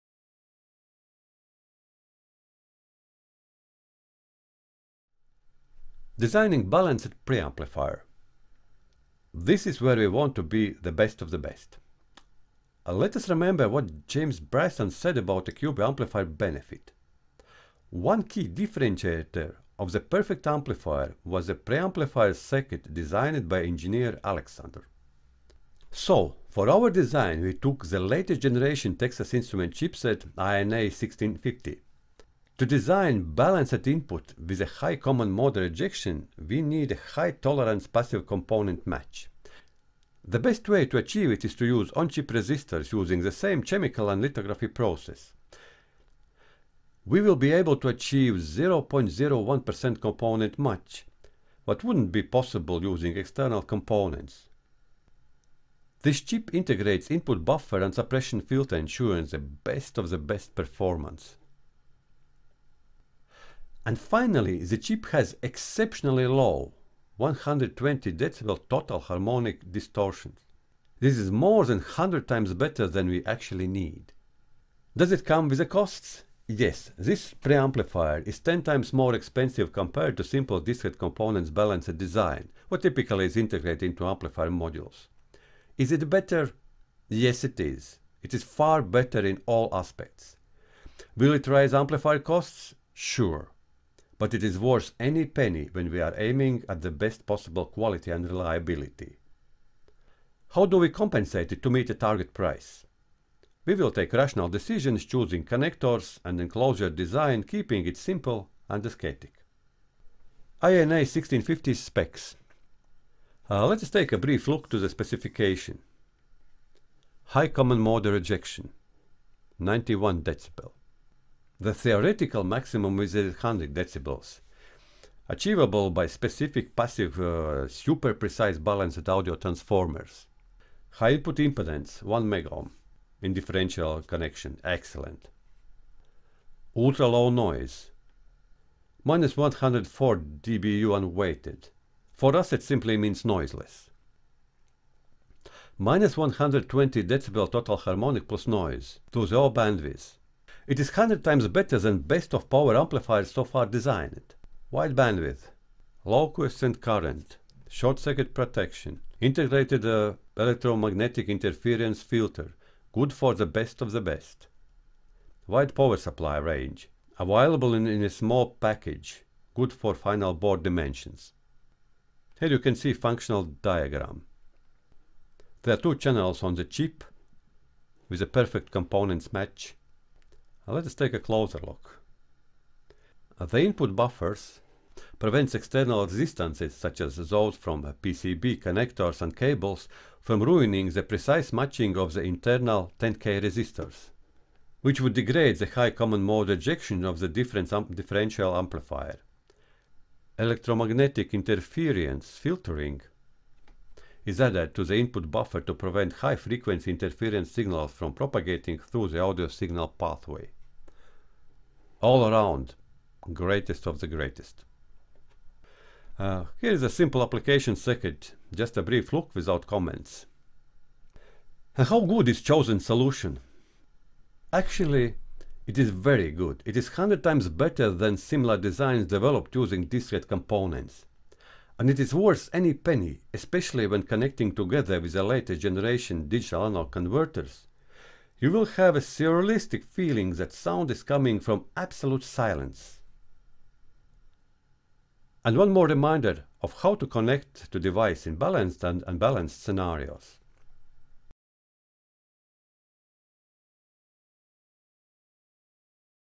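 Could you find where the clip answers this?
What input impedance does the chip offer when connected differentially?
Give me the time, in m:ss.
2:12.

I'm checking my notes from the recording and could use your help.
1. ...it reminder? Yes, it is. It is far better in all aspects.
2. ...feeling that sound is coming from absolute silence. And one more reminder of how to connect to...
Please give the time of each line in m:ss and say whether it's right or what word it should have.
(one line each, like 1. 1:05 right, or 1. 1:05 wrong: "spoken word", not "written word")
1. 1:25 wrong: "better", not "reminder"
2. 3:59 right.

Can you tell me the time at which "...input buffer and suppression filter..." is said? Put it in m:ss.
0:57.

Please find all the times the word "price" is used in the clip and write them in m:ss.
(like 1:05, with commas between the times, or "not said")
1:42.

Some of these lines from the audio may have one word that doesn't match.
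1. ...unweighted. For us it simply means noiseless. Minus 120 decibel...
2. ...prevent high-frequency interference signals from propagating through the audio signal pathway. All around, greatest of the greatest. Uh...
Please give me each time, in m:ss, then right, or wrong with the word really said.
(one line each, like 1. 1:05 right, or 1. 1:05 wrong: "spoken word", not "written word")
1. 2:20 right
2. 3:25 right.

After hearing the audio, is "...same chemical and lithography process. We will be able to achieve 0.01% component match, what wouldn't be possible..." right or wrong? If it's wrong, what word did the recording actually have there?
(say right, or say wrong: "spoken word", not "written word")
right.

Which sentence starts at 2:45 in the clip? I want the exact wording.
Wide power supply range, available in, in a small package, good for final board dimensions.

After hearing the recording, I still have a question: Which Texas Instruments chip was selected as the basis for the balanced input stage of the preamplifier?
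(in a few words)
INA1650.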